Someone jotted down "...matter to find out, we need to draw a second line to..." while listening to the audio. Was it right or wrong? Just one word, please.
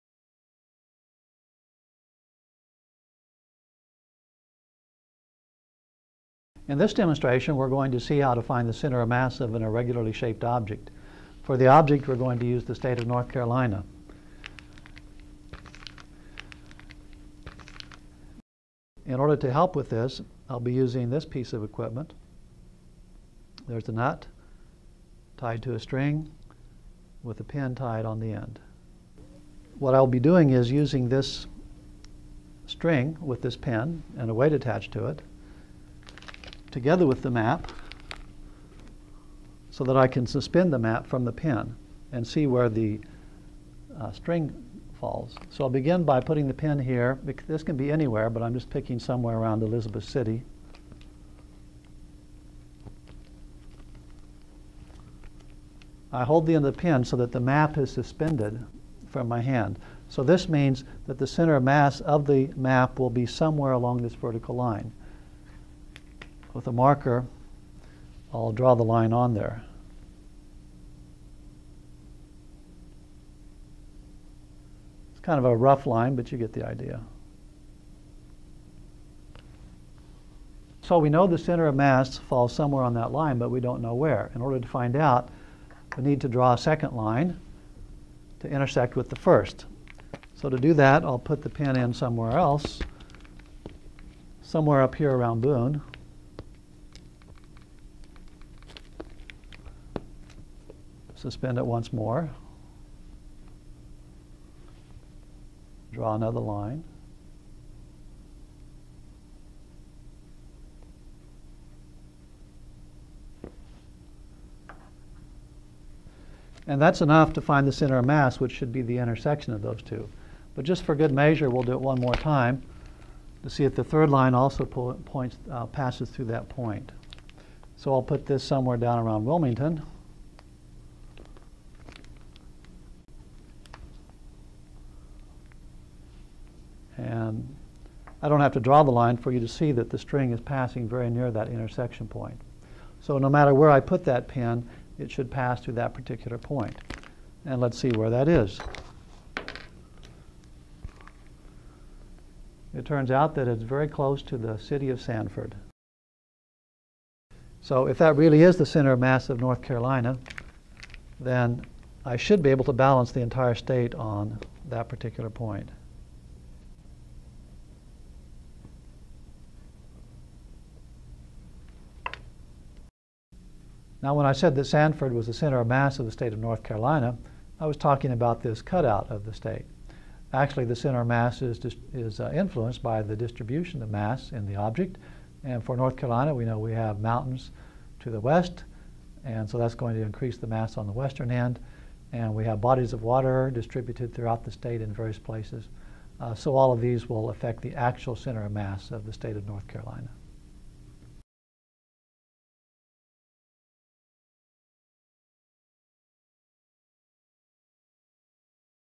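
wrong.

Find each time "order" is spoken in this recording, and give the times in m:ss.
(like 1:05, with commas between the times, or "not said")
0:19, 1:24.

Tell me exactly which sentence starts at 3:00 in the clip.
Actually, the center of mass is, is uh, influenced by the distribution of mass in the object.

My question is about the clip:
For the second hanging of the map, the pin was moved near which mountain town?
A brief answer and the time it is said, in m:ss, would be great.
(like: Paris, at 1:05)
Boone, at 1:35.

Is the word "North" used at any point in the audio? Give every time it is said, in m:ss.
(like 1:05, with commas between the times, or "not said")
0:13, 2:39, 2:56, 3:05, 3:19.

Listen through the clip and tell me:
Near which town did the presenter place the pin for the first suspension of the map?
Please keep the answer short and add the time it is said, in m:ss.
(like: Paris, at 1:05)
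Elizabeth City, at 0:49.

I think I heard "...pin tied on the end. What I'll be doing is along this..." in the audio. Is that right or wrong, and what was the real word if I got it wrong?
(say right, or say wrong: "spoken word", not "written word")
wrong: "using", not "along".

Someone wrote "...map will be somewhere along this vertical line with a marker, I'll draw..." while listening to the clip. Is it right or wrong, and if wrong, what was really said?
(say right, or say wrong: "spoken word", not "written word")
right.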